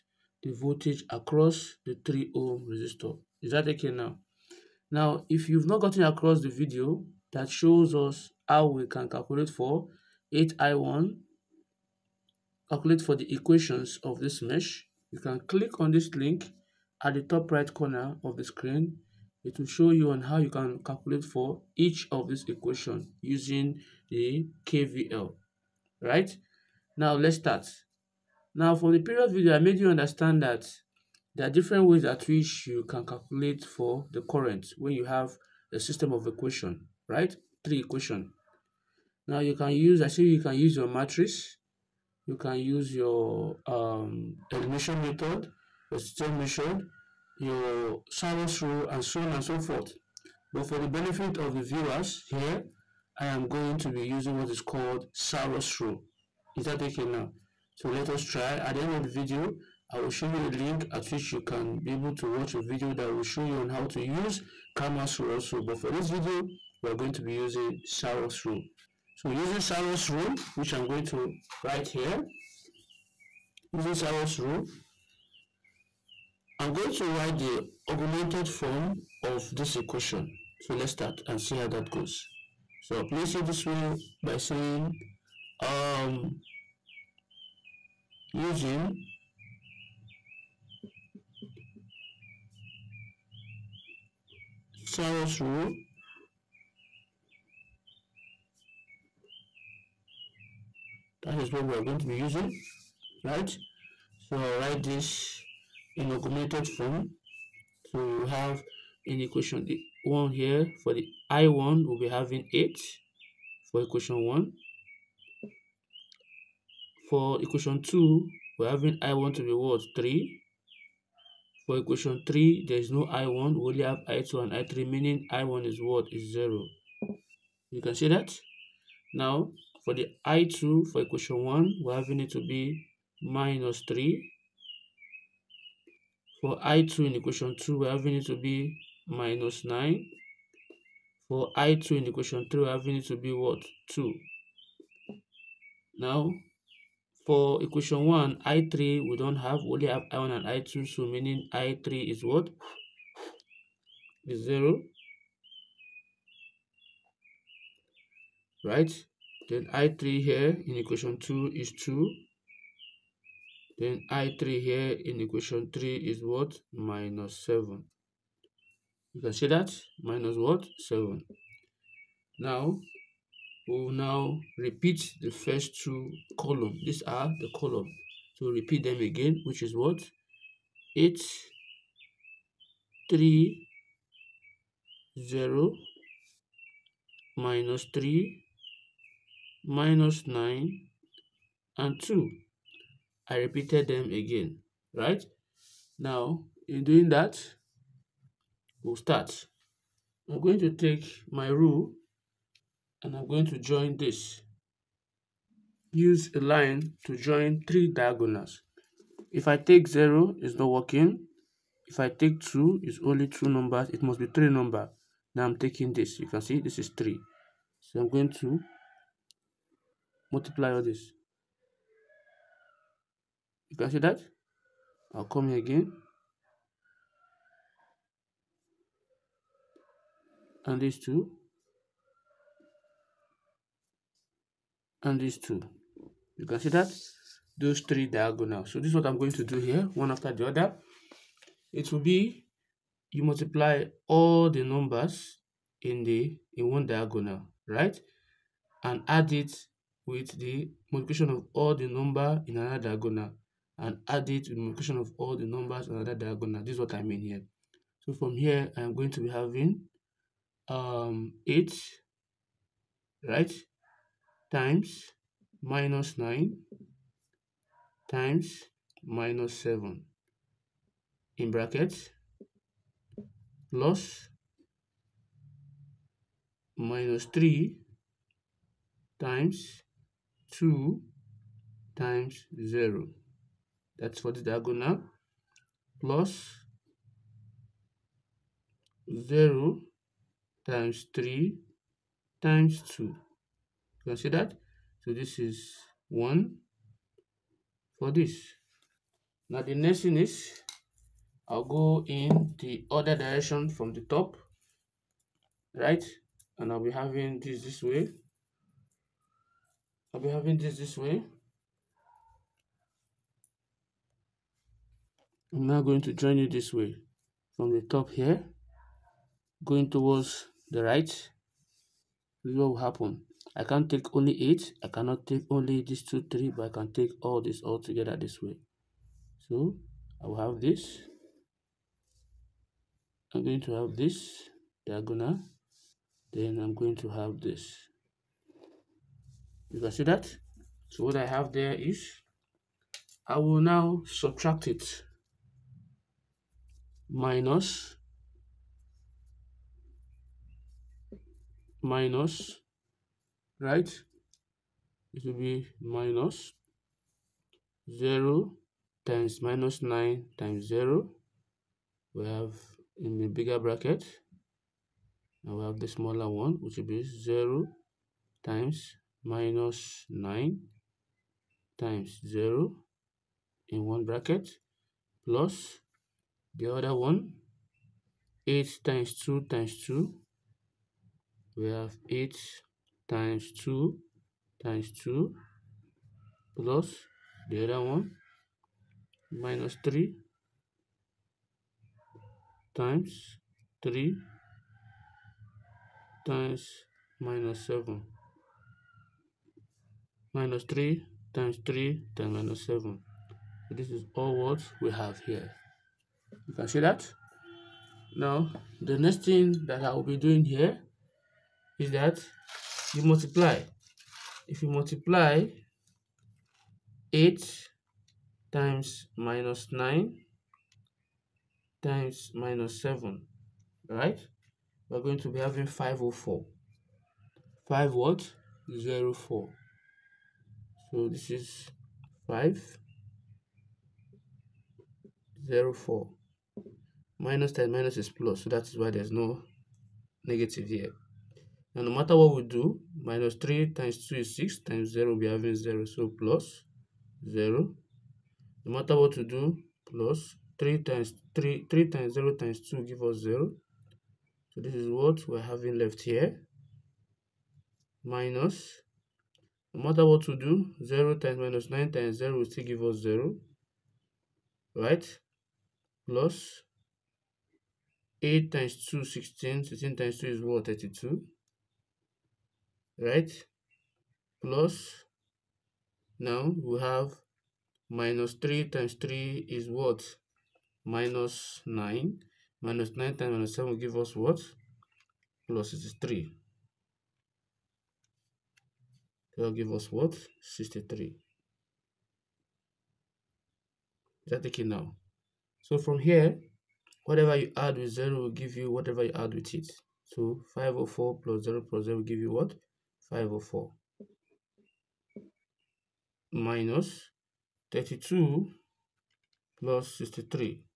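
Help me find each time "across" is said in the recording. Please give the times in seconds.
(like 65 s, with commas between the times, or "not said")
1 s, 6 s.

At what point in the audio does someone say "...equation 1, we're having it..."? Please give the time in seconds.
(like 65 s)
131 s.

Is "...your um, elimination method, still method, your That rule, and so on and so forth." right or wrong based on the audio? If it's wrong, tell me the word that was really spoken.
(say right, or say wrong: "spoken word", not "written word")
wrong: "Sarrus", not "That".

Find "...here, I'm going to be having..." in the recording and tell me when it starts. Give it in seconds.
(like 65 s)
258 s.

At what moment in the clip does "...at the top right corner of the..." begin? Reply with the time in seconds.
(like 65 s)
17 s.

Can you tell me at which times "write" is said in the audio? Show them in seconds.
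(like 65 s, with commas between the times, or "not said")
71 s, 77 s, 104 s.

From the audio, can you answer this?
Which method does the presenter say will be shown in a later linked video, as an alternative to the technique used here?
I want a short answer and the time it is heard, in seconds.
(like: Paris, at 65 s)
Cramer's rule, at 64 s.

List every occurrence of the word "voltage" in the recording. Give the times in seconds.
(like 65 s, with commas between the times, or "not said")
0 s.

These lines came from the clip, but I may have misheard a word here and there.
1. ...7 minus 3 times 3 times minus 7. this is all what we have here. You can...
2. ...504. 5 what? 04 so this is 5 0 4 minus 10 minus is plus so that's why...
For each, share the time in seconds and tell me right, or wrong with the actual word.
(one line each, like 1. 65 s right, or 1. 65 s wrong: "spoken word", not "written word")
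1. 397 s right
2. 425 s right.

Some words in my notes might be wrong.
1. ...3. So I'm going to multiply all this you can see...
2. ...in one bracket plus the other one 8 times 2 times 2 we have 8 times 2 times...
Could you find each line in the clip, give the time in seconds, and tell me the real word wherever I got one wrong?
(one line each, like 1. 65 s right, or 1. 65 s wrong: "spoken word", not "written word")
1. 216 s right
2. 373 s right.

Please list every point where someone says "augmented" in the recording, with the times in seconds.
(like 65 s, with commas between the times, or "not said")
77 s, 106 s.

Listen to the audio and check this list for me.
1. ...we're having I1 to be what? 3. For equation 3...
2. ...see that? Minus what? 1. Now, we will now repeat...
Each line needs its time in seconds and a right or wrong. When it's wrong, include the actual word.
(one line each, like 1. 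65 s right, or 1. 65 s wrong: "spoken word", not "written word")
1. 118 s right
2. 169 s wrong: "7", not "1".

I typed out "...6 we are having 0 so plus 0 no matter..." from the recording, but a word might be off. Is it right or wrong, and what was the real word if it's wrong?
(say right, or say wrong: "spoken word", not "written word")
wrong: "0", not "6".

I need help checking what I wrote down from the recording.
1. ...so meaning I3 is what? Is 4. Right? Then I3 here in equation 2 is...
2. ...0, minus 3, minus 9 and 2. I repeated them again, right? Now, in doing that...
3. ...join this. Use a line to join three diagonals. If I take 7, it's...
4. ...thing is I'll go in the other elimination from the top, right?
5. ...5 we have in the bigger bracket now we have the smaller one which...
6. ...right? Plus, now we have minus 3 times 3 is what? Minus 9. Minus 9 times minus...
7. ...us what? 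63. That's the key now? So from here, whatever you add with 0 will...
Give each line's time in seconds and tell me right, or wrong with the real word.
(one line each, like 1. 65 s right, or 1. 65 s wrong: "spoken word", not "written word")
1. 150 s wrong: "0", not "4"
2. 185 s right
3. 203 s wrong: "0", not "7"
4. 300 s wrong: "direction", not "elimination"
5. 360 s wrong: "0", not "5"
6. 472 s right
7. 489 s right.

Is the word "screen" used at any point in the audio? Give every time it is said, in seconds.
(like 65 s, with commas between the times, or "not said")
18 s.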